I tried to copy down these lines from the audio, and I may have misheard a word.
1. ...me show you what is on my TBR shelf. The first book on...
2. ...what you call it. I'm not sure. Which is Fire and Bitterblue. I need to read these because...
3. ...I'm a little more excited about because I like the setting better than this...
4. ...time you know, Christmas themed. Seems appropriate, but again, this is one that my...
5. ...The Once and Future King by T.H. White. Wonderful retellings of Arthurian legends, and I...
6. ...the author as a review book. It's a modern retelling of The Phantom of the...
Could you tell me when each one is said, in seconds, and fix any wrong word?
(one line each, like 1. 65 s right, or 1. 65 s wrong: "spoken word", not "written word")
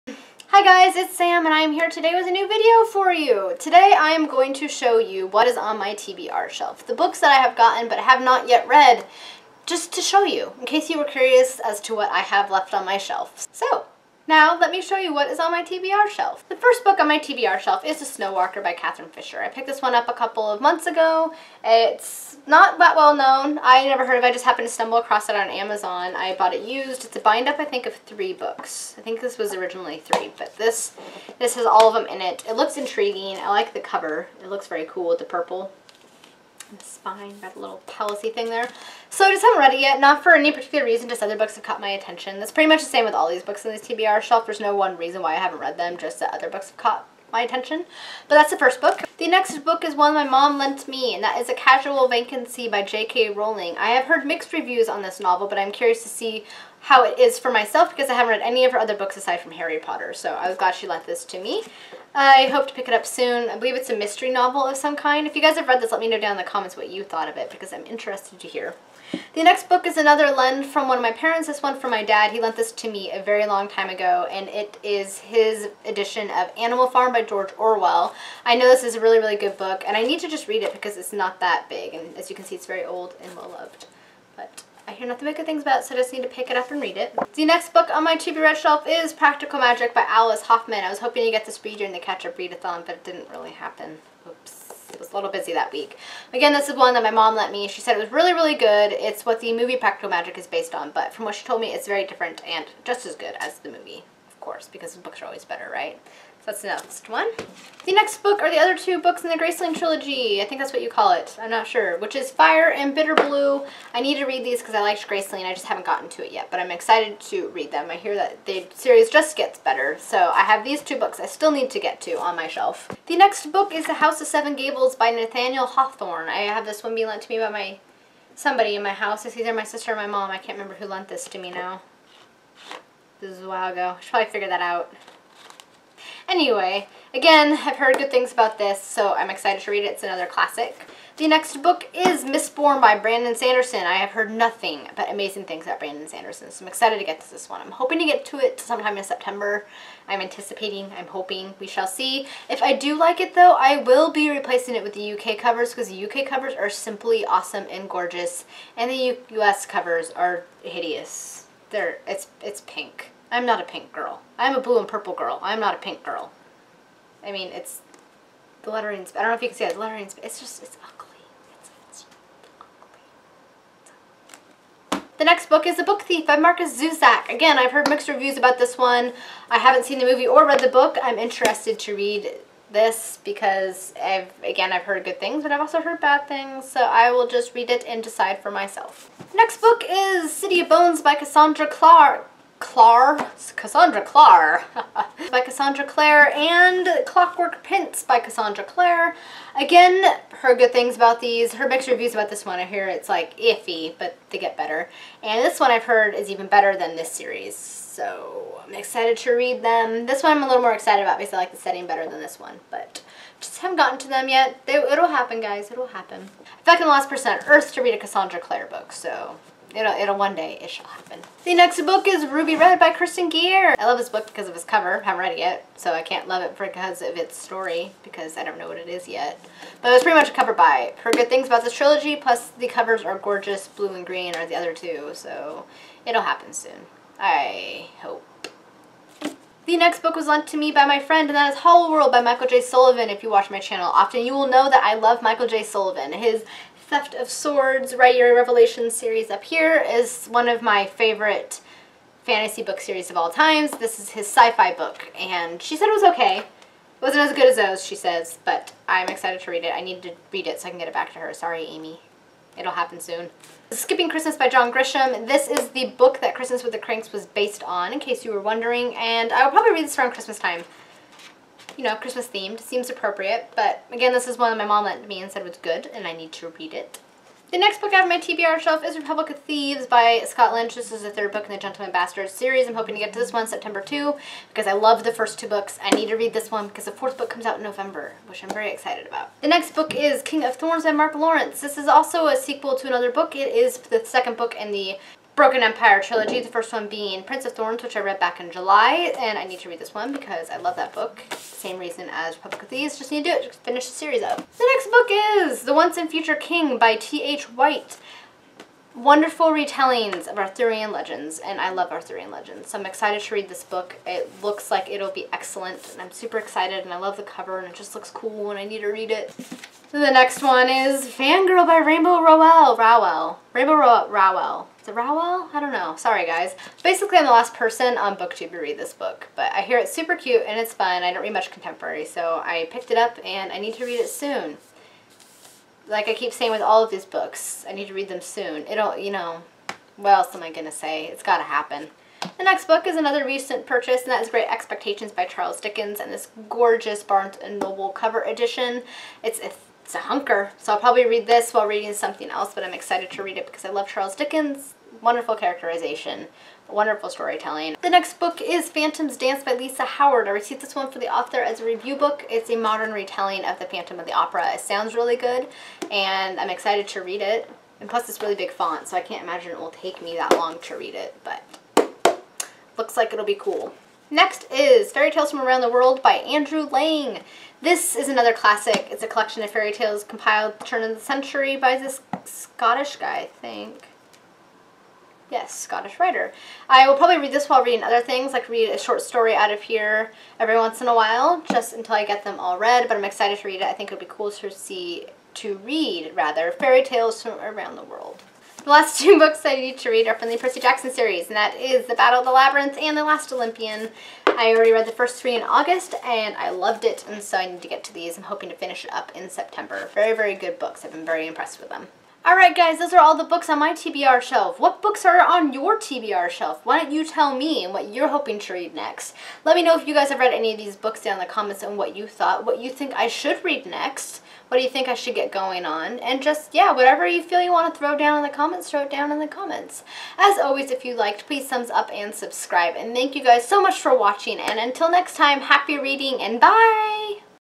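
1. 14 s right
2. 110 s right
3. 210 s right
4. 270 s right
5. 305 s right
6. 360 s right.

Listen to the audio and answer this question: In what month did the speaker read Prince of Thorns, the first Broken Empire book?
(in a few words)
July.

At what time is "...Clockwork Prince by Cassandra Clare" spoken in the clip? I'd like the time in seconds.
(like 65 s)
197 s.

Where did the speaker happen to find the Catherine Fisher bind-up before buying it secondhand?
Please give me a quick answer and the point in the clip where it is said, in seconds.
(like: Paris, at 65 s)
Amazon, at 25 s.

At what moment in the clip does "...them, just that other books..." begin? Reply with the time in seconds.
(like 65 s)
45 s.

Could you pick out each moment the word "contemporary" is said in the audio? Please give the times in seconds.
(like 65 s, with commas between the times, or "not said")
331 s.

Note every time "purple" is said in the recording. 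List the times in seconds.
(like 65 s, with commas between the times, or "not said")
35 s, 164 s.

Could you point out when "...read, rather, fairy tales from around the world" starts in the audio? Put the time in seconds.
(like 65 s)
395 s.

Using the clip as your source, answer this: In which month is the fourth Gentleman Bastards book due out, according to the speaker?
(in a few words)
November.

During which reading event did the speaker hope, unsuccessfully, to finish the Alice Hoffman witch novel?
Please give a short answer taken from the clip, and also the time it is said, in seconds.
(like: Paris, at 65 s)
Catch Up Readathon, at 91 s.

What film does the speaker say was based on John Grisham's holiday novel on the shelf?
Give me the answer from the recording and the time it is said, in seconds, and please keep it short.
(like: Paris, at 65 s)
Christmas with the Cranks, at 266 s.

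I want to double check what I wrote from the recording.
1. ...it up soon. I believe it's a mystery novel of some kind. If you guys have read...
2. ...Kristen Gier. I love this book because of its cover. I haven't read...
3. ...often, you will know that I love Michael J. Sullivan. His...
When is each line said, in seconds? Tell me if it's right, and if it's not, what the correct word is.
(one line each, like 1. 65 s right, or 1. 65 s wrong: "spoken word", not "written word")
1. 62 s right
2. 222 s right
3. 243 s right.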